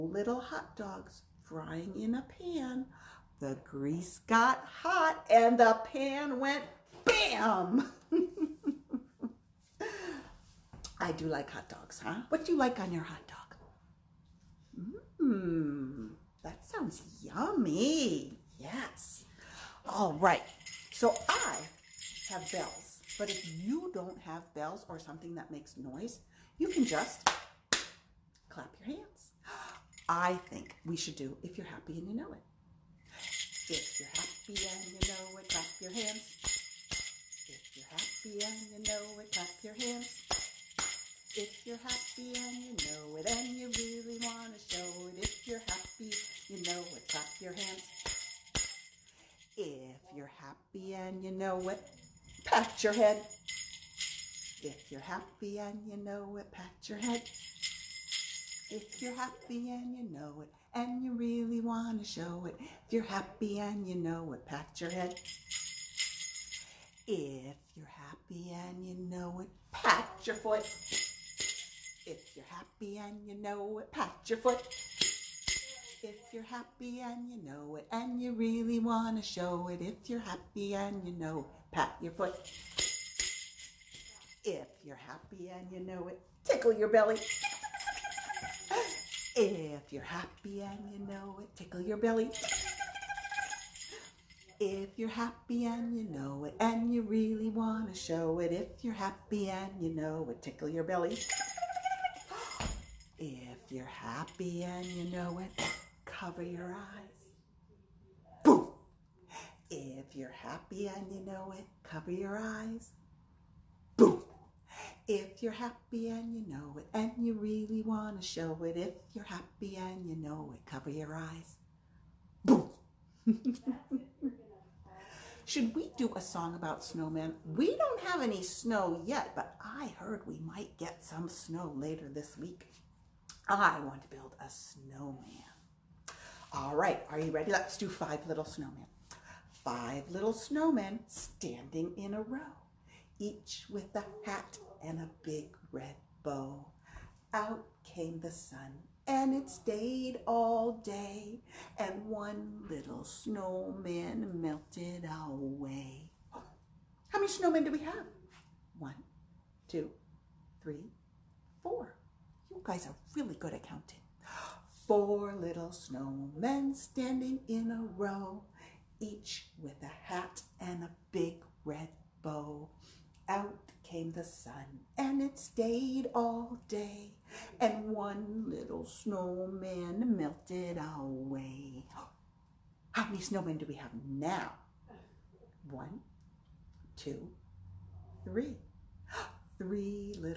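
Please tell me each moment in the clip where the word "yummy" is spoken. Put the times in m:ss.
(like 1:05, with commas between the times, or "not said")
0:17.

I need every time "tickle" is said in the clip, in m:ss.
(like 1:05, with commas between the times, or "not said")
1:26, 1:31, 1:40.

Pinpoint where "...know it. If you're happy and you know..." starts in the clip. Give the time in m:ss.
0:32.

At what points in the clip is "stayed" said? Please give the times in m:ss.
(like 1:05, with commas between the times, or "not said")
2:29, 2:55.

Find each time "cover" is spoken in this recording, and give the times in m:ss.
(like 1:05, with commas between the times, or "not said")
1:46, 1:51, 2:00.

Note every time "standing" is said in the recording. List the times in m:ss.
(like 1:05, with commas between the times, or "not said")
2:21, 2:46.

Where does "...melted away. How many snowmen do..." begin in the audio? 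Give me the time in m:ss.
2:34.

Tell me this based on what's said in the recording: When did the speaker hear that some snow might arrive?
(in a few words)
Later this week.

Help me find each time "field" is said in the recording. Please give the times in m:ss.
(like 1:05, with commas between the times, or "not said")
not said.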